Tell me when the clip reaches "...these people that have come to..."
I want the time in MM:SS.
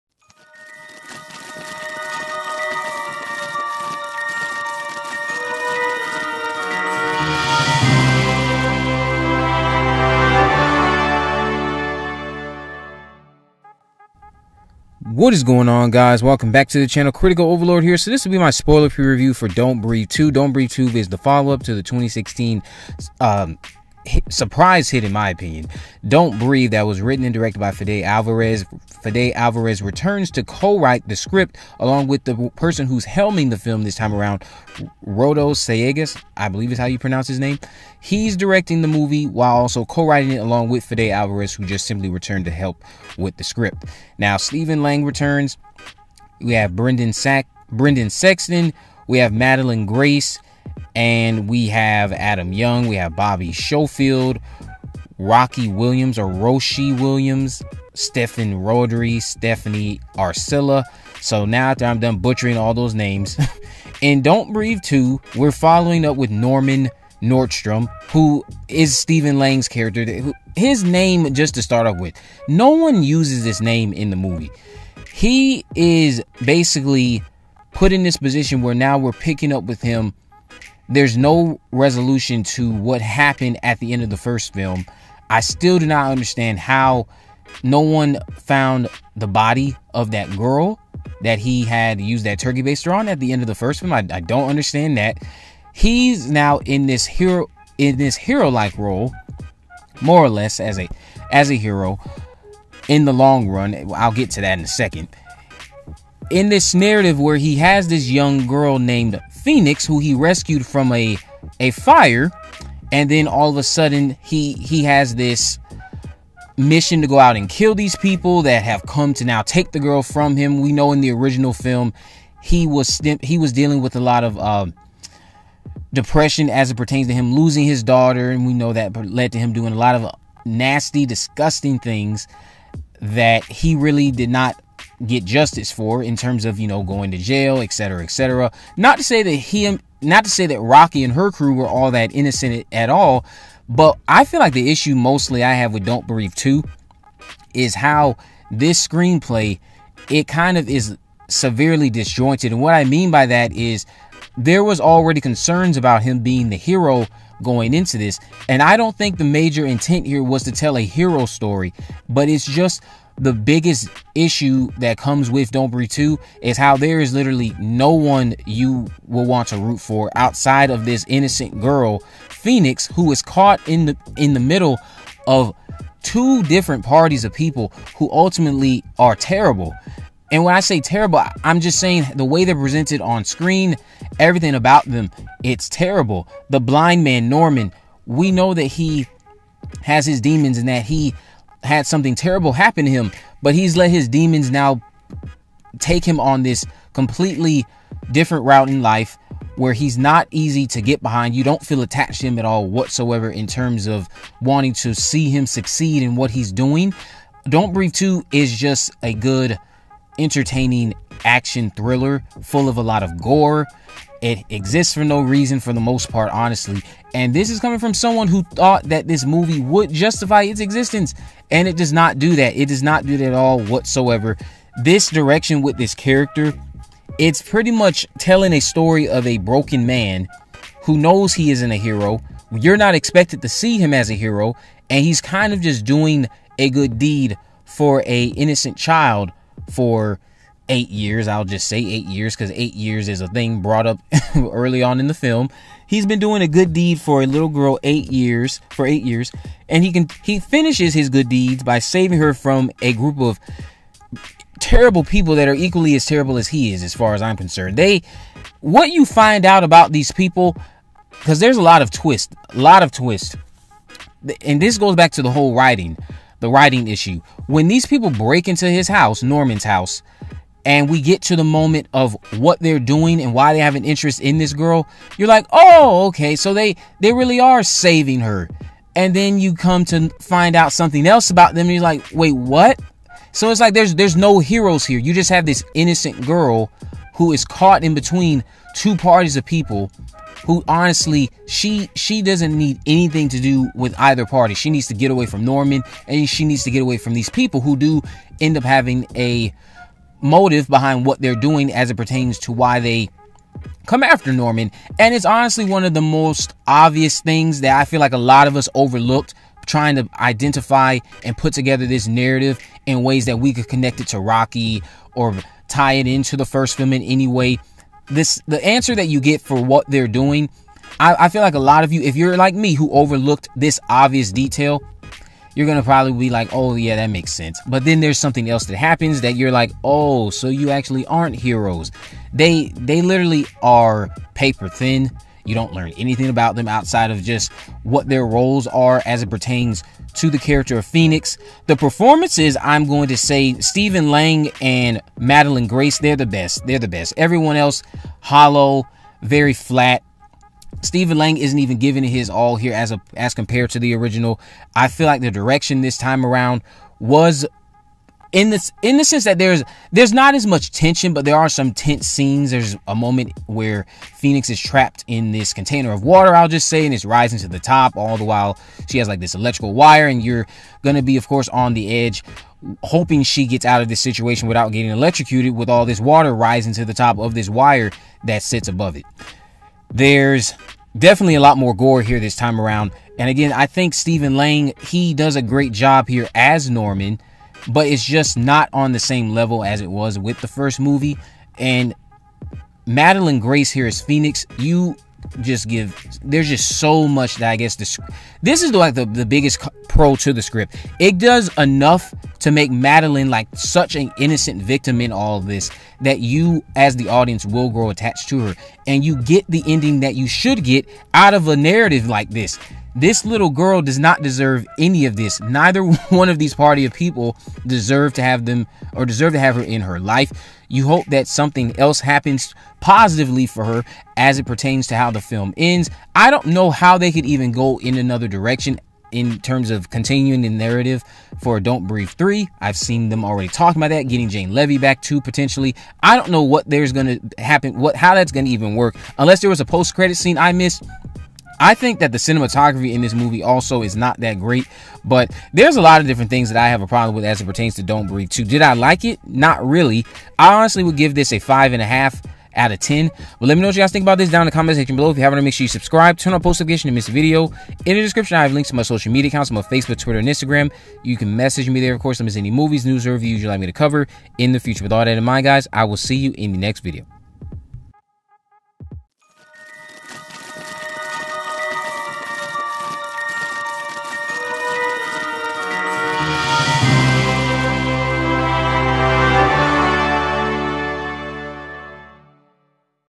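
01:57.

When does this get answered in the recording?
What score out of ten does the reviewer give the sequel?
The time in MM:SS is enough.
07:31.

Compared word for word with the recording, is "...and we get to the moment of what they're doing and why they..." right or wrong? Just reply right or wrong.
right.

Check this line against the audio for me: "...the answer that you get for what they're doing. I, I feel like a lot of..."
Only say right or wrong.
right.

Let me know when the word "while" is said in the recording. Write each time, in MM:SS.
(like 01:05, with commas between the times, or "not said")
00:39, 06:08.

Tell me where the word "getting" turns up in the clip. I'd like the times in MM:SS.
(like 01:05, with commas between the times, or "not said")
06:14, 07:14.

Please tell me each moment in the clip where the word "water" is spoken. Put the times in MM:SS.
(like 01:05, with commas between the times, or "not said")
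06:06, 06:15.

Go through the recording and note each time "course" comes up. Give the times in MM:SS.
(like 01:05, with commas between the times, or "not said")
06:11, 07:42.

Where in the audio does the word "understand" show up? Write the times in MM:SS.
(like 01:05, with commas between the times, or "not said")
01:26, 01:34.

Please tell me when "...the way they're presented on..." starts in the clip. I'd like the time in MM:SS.
03:02.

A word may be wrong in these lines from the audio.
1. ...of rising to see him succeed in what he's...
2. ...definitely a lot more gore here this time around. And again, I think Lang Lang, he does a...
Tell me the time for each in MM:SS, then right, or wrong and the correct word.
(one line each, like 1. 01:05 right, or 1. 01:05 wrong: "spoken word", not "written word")
1. 03:23 wrong: "wanting", not "rising"
2. 06:20 wrong: "Stephen", not "Lang".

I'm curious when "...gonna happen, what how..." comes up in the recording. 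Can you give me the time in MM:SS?
07:16.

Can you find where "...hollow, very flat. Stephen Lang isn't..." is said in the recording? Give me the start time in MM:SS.
05:48.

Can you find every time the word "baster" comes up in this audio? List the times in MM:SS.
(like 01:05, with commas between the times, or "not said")
01:32.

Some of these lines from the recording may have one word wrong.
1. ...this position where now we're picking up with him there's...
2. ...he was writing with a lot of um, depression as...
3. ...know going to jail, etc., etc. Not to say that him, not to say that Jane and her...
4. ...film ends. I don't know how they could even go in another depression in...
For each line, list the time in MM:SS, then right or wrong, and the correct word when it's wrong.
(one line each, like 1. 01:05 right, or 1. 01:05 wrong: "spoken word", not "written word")
1. 01:18 right
2. 02:03 wrong: "dealing", not "writing"
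3. 02:16 wrong: "Rocky", not "Jane"
4. 07:05 wrong: "direction", not "depression".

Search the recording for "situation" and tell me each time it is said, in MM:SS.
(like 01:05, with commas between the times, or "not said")
06:13.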